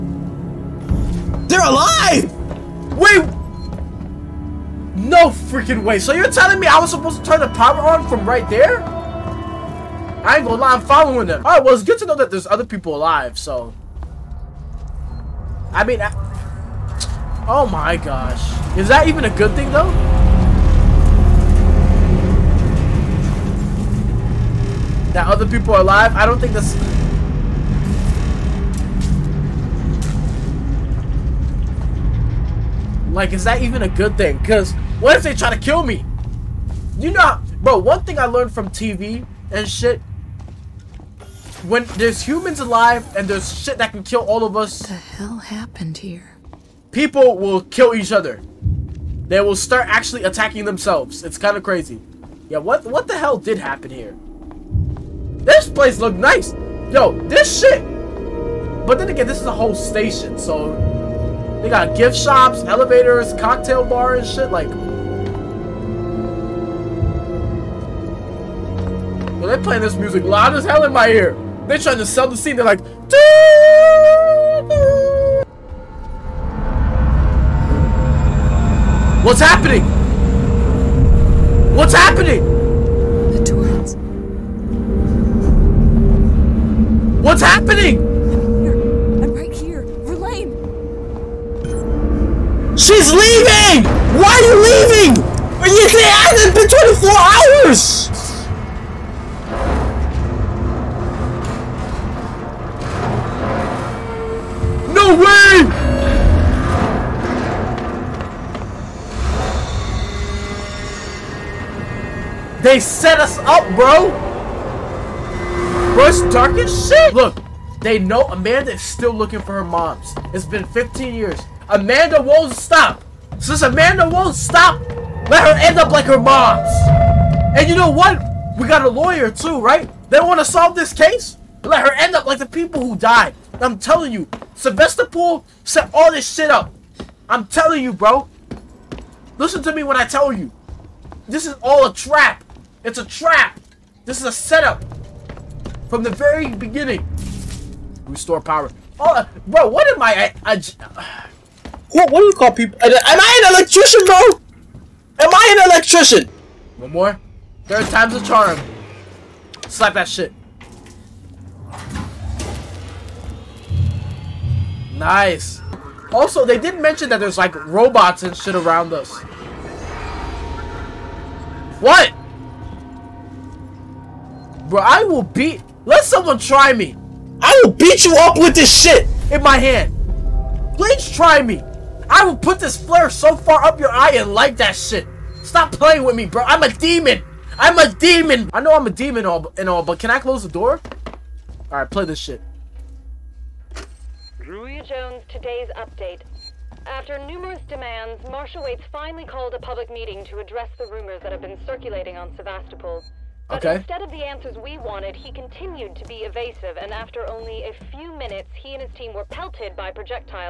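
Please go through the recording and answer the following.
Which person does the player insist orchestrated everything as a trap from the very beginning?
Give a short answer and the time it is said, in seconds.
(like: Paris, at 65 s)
Sylvester Pool, at 134 s.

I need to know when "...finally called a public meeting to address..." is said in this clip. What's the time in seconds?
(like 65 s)
198 s.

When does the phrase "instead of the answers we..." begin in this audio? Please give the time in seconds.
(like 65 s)
203 s.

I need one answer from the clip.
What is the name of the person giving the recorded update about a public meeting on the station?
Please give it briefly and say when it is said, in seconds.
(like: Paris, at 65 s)
Julia Jones, at 194 s.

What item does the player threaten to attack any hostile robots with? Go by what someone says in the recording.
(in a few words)
flare.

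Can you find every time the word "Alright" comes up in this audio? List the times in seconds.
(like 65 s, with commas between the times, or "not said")
11 s.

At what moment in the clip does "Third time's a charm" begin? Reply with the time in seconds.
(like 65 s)
157 s.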